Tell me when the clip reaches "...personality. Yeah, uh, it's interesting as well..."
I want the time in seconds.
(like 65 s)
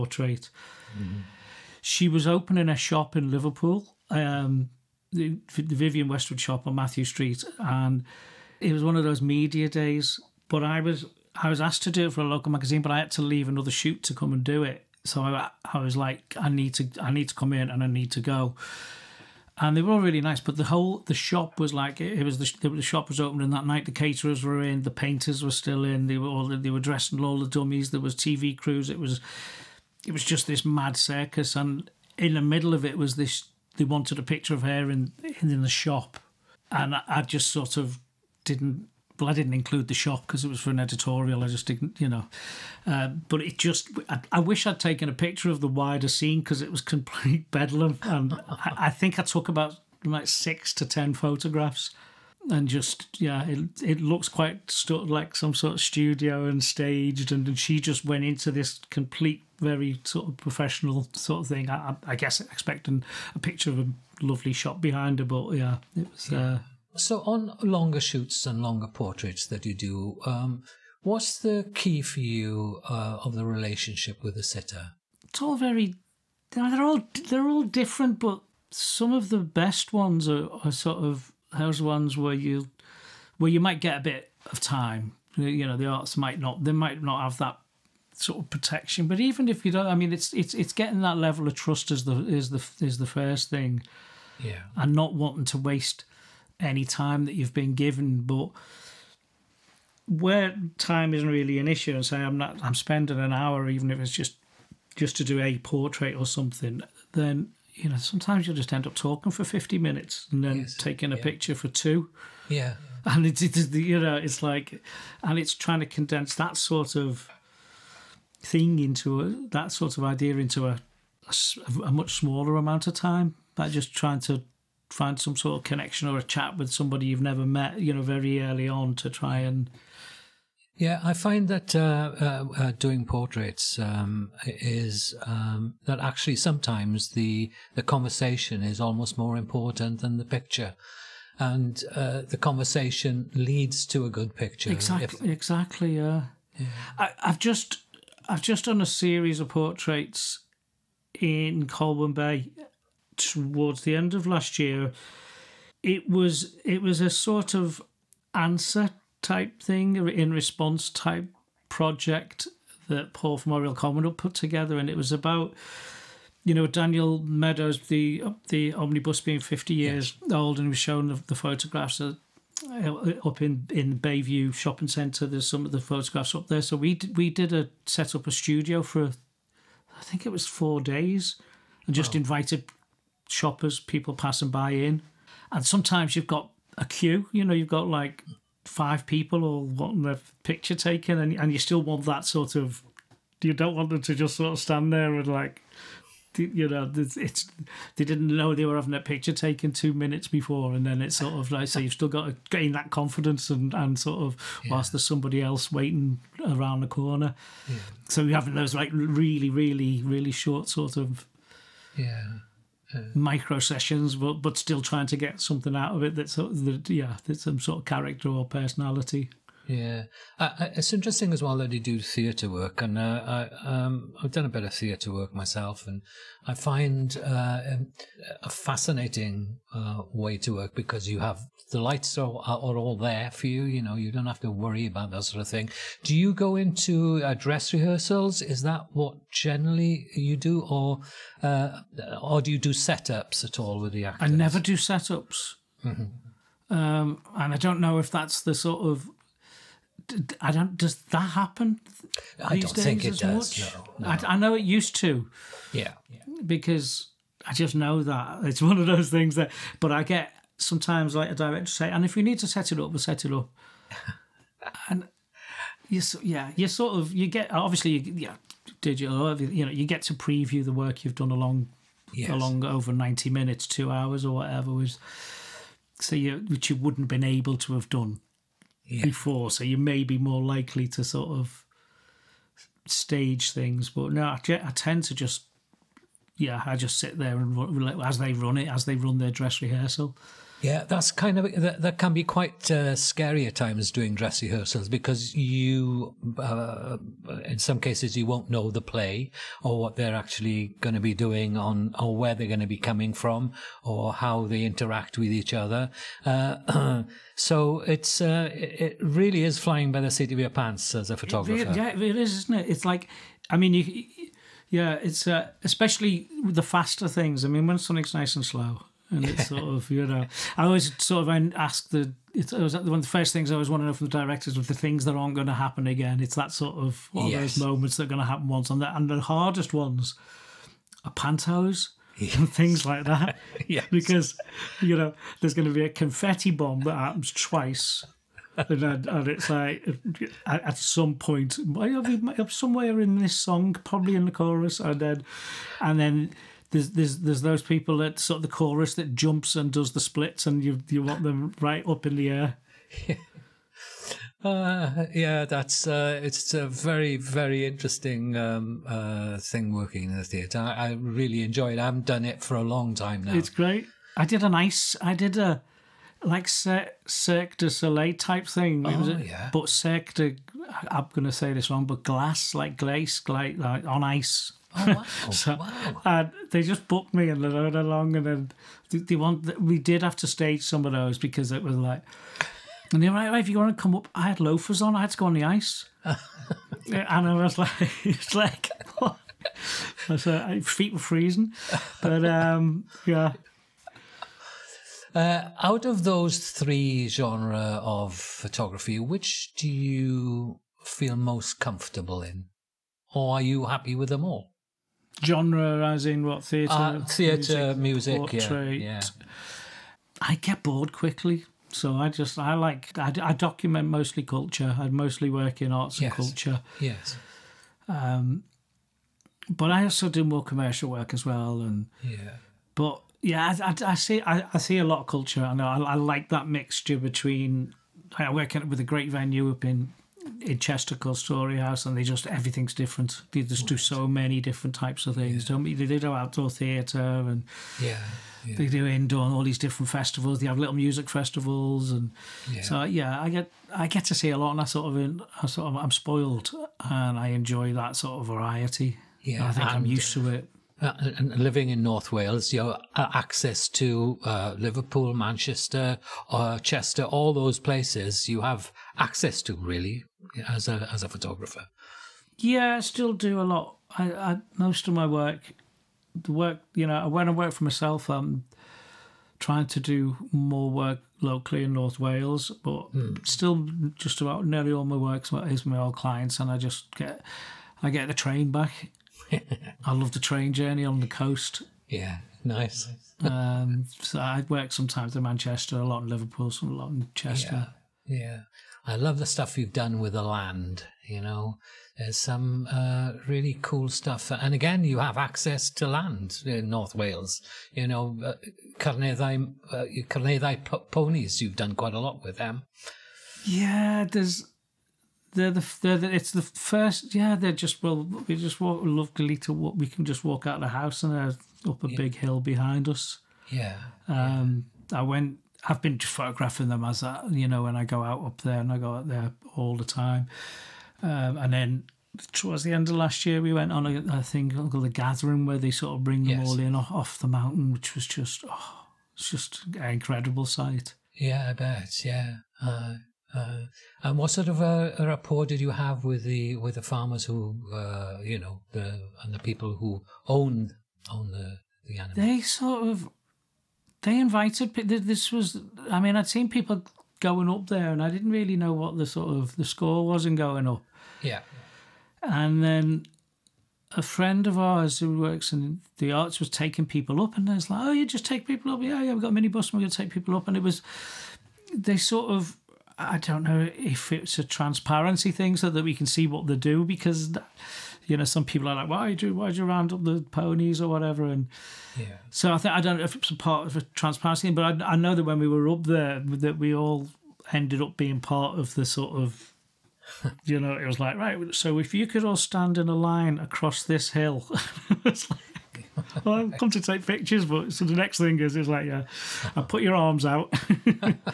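218 s.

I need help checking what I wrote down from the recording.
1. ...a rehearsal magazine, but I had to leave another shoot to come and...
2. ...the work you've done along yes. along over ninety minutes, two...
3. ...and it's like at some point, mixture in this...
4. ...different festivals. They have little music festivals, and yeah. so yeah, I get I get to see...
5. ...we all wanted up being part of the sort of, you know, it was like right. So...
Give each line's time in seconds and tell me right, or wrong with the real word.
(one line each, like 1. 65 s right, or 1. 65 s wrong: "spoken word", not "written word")
1. 12 s wrong: "local", not "rehearsal"
2. 270 s right
3. 339 s wrong: "somewhere", not "mixture"
4. 439 s right
5. 576 s wrong: "ended", not "wanted".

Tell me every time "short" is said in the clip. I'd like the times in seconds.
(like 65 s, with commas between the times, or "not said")
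210 s.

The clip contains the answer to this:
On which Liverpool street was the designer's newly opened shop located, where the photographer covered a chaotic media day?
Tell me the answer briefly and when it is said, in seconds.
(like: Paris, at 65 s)
Mathew Street, at 6 s.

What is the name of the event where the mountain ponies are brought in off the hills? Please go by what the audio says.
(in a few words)
The Gathering.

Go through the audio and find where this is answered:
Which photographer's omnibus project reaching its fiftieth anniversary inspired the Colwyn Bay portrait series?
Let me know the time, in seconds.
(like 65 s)
166 s.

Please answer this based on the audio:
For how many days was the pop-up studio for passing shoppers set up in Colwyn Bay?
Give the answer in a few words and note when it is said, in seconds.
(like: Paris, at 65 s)
4, at 180 s.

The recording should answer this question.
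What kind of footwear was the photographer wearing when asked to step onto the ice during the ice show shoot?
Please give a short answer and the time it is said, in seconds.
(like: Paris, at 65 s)
Loafers, at 384 s.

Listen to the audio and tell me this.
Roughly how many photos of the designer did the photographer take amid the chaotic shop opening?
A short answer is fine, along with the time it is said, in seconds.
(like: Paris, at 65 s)
6 to 10, at 50 s.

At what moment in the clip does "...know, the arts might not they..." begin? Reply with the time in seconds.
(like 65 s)
85 s.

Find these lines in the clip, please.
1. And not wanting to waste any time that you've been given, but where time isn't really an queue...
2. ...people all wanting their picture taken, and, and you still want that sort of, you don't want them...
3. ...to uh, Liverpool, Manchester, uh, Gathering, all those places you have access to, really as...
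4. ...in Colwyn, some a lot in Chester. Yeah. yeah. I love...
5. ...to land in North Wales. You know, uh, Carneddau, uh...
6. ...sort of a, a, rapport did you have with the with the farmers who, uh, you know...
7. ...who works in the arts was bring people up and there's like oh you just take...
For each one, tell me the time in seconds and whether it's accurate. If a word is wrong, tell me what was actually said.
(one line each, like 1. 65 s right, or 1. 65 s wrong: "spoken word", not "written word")
1. 94 s wrong: "issue", not "queue"
2. 189 s right
3. 453 s wrong: "Chester", not "Gathering"
4. 486 s wrong: "Liverpool", not "Colwyn"
5. 495 s right
6. 534 s right
7. 554 s wrong: "taking", not "bring".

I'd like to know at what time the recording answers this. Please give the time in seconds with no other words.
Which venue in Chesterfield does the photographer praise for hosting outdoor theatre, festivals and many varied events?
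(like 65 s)
431 s.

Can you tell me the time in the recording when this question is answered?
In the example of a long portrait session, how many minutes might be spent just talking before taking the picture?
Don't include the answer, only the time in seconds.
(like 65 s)
109 s.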